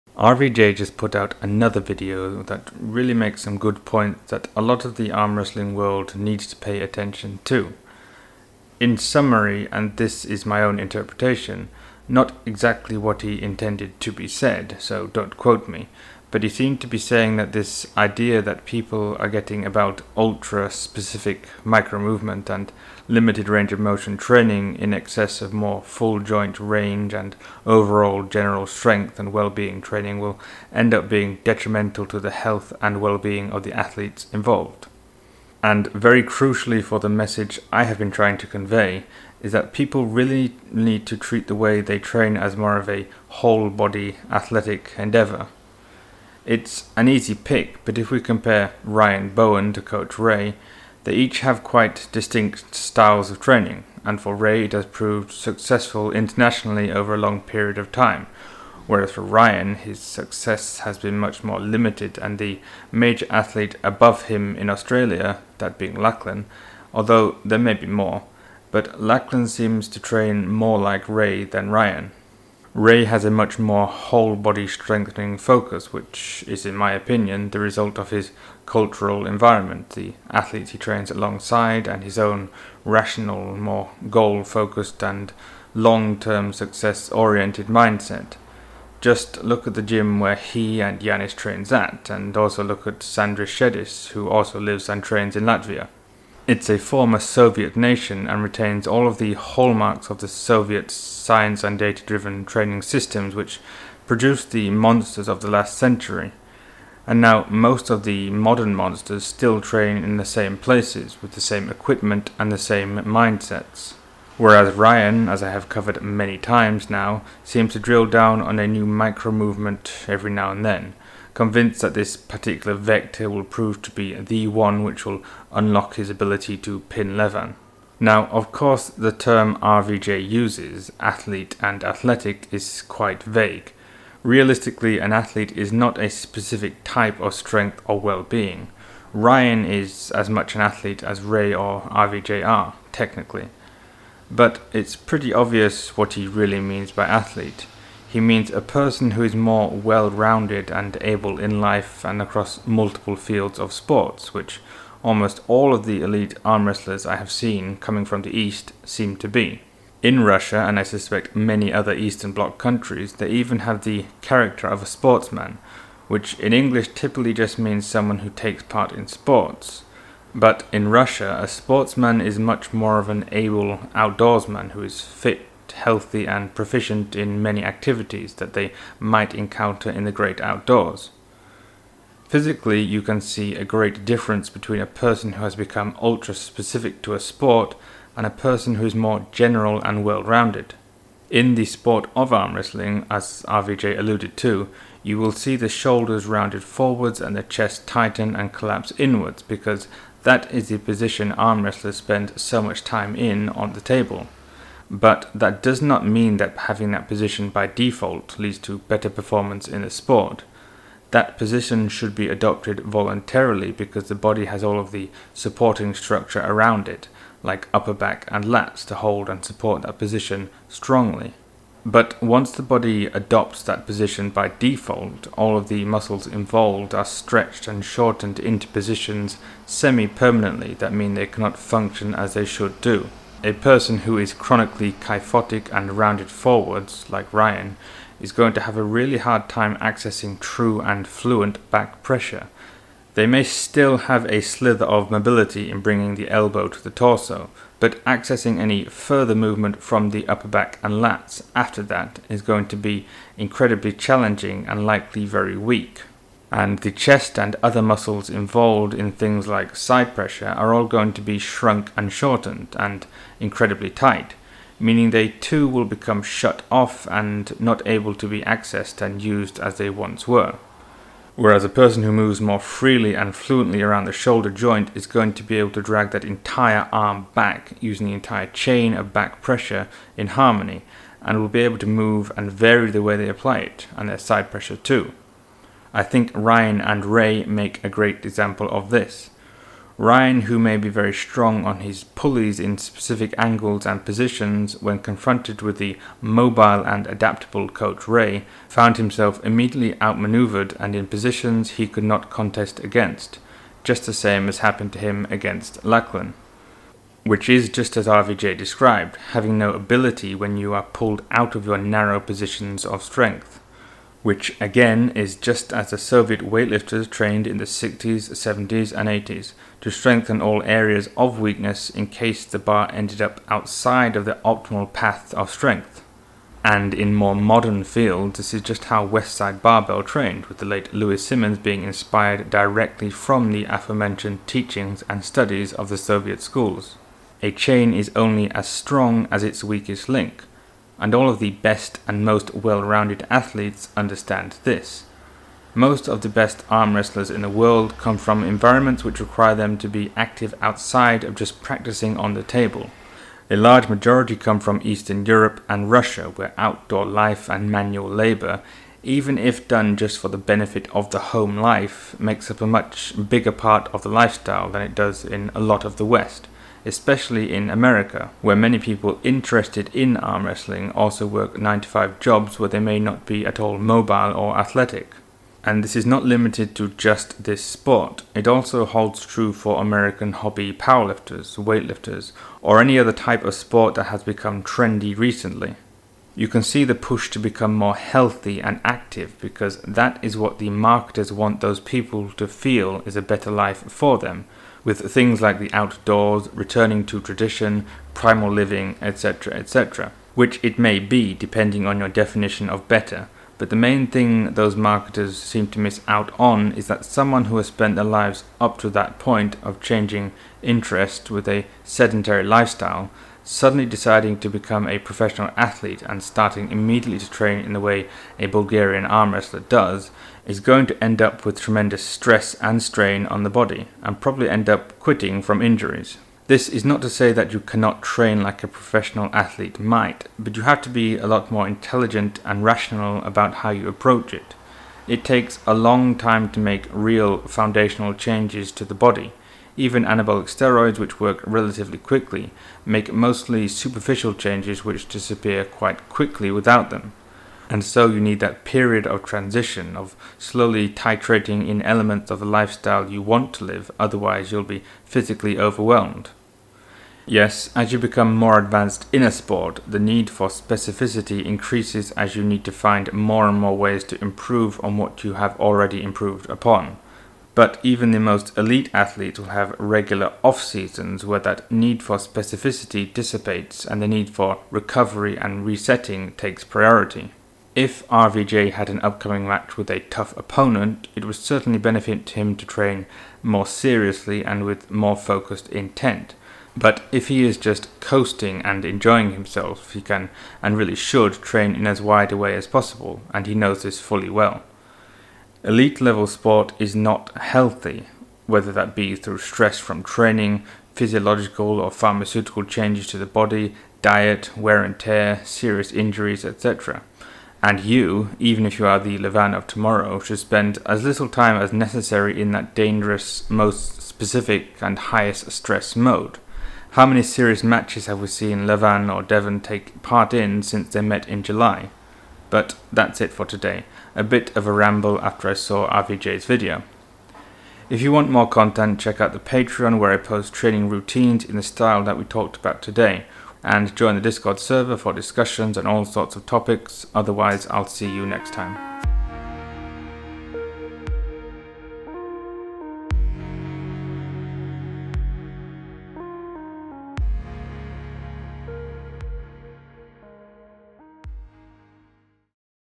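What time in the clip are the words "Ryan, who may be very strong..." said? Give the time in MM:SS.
04:50.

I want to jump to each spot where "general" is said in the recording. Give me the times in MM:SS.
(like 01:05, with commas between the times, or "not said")
00:28, 03:09.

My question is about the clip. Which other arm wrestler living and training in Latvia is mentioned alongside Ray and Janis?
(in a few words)
Sandris Sedis.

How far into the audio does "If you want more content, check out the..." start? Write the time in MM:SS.
08:47.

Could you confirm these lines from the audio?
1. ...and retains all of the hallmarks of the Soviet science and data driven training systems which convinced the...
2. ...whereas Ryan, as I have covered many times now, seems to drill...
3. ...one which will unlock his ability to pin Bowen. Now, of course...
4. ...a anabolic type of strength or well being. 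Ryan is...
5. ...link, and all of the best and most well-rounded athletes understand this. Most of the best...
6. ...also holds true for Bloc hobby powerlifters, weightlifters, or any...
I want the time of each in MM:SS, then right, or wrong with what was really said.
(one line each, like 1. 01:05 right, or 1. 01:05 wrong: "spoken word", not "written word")
1. 01:38 wrong: "produced", not "convinced"
2. 01:54 right
3. 02:04 wrong: "Levan", not "Bowen"
4. 02:15 wrong: "specific", not "anabolic"
5. 05:40 right
6. 06:18 wrong: "American", not "Bloc".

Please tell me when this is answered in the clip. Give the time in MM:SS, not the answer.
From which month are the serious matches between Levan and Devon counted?
08:41.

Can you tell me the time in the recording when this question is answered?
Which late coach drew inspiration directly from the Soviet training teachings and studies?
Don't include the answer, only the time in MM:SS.
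05:30.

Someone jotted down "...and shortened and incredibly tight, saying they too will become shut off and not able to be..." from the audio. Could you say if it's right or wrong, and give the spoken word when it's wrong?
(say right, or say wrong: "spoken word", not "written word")
wrong: "meaning", not "saying".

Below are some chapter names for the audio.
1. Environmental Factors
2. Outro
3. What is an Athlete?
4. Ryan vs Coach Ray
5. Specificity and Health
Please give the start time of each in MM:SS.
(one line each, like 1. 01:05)
1. 05:45
2. 08:47
3. 02:08
4. 00:48
5. 07:37.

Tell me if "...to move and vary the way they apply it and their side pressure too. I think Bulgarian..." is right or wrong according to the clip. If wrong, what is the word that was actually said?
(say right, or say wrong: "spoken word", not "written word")
wrong: "Ryan", not "Bulgarian".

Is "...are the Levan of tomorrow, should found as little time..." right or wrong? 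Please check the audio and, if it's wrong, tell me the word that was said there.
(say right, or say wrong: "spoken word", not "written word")
wrong: "spend", not "found".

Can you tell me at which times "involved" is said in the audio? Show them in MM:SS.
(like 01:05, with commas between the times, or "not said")
00:34, 03:46, 04:18.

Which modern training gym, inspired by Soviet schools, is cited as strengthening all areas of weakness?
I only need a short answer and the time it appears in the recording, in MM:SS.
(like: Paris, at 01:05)
Westside Barbell, at 05:29.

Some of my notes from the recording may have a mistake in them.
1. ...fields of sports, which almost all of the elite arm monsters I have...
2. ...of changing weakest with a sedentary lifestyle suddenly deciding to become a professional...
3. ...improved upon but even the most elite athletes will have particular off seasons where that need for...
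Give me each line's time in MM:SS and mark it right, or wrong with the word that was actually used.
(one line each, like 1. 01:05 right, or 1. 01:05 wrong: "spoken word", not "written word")
1. 02:33 wrong: "wrestlers", not "monsters"
2. 06:49 wrong: "interest", not "weakest"
3. 07:46 wrong: "regular", not "particular".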